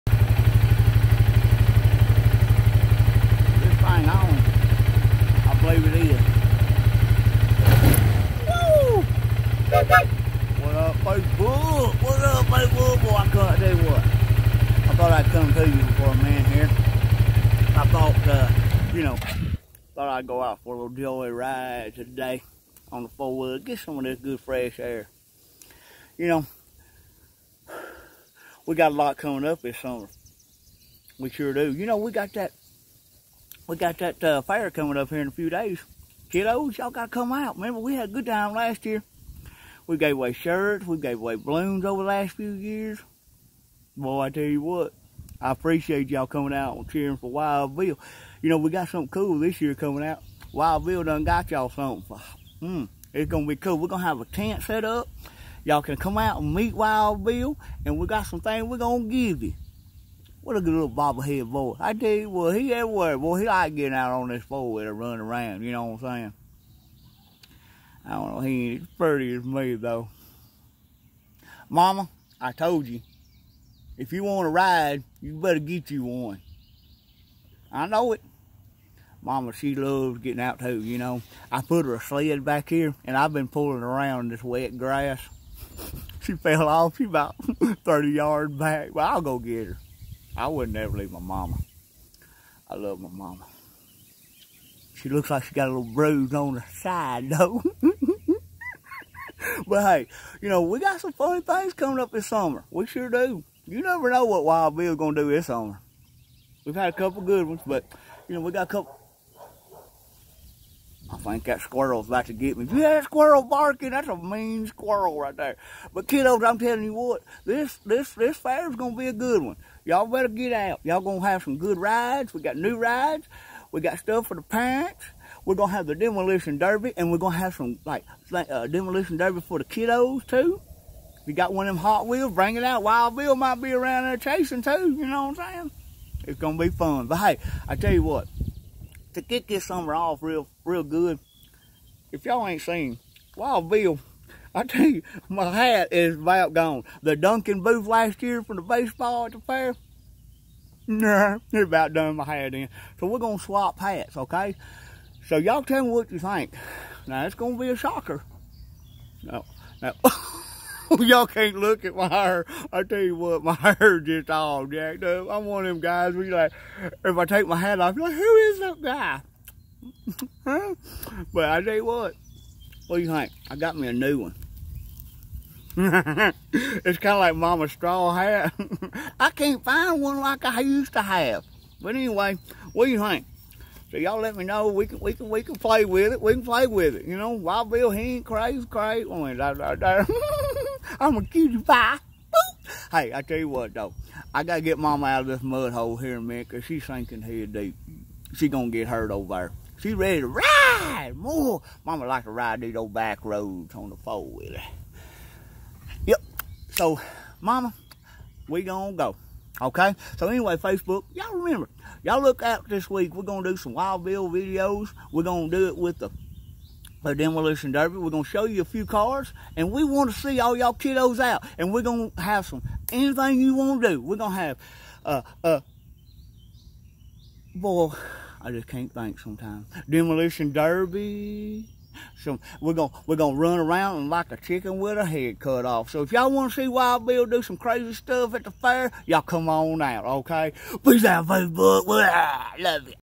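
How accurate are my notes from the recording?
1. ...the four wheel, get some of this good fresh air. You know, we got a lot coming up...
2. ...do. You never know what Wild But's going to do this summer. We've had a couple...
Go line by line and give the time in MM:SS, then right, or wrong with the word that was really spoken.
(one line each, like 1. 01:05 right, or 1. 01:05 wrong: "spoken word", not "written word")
1. 00:23 right
2. 01:43 wrong: "Bill", not "But".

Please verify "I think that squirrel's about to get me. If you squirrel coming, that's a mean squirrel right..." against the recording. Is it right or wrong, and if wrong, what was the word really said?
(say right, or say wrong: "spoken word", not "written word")
wrong: "barking", not "coming".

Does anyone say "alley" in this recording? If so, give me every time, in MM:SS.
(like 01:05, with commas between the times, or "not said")
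not said.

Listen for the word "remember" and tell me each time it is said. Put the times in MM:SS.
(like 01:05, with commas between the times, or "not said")
00:37, 03:31.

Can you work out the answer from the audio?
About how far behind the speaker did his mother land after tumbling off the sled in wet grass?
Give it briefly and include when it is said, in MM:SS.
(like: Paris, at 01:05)
30 yards, at 01:27.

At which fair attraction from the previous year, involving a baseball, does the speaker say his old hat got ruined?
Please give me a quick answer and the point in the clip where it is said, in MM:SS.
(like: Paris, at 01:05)
dunking booth, at 02:27.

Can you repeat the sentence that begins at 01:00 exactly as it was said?
What a good little bobblehead boy.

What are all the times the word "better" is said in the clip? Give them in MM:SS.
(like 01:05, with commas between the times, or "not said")
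01:15, 02:00.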